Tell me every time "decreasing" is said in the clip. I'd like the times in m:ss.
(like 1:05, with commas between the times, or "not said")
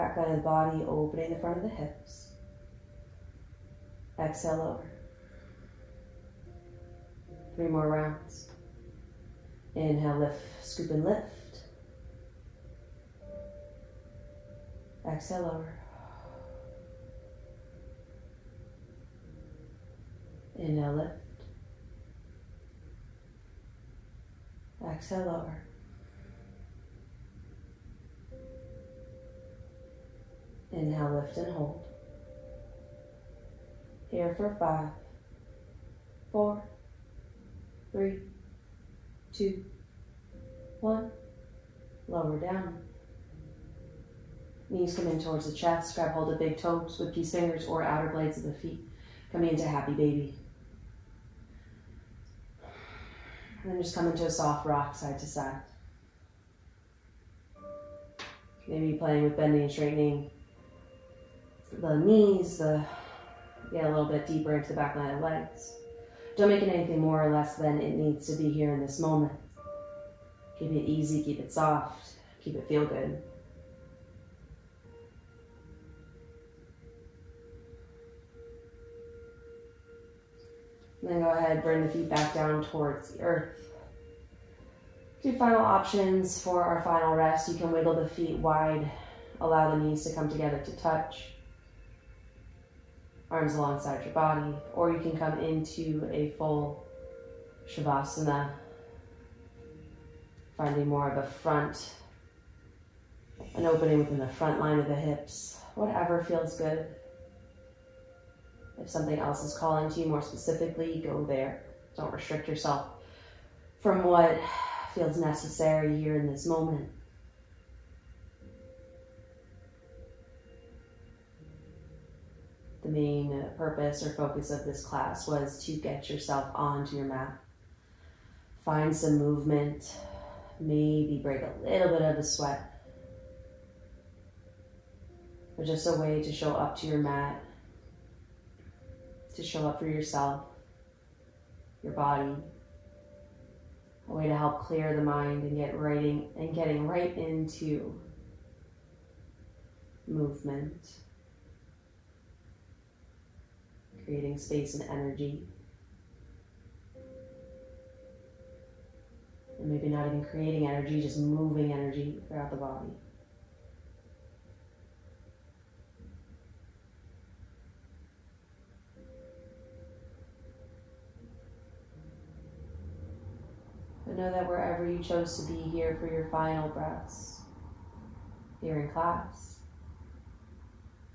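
not said.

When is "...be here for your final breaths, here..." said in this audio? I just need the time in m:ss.
2:55.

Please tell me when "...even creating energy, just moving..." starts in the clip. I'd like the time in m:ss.
2:40.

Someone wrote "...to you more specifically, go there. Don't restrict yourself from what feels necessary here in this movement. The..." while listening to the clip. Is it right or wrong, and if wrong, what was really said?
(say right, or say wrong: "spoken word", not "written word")
wrong: "moment", not "movement".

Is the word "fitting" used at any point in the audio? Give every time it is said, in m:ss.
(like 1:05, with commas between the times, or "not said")
not said.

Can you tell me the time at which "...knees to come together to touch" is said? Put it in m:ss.
1:29.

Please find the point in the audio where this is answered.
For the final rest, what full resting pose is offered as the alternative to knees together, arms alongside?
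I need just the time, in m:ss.
1:37.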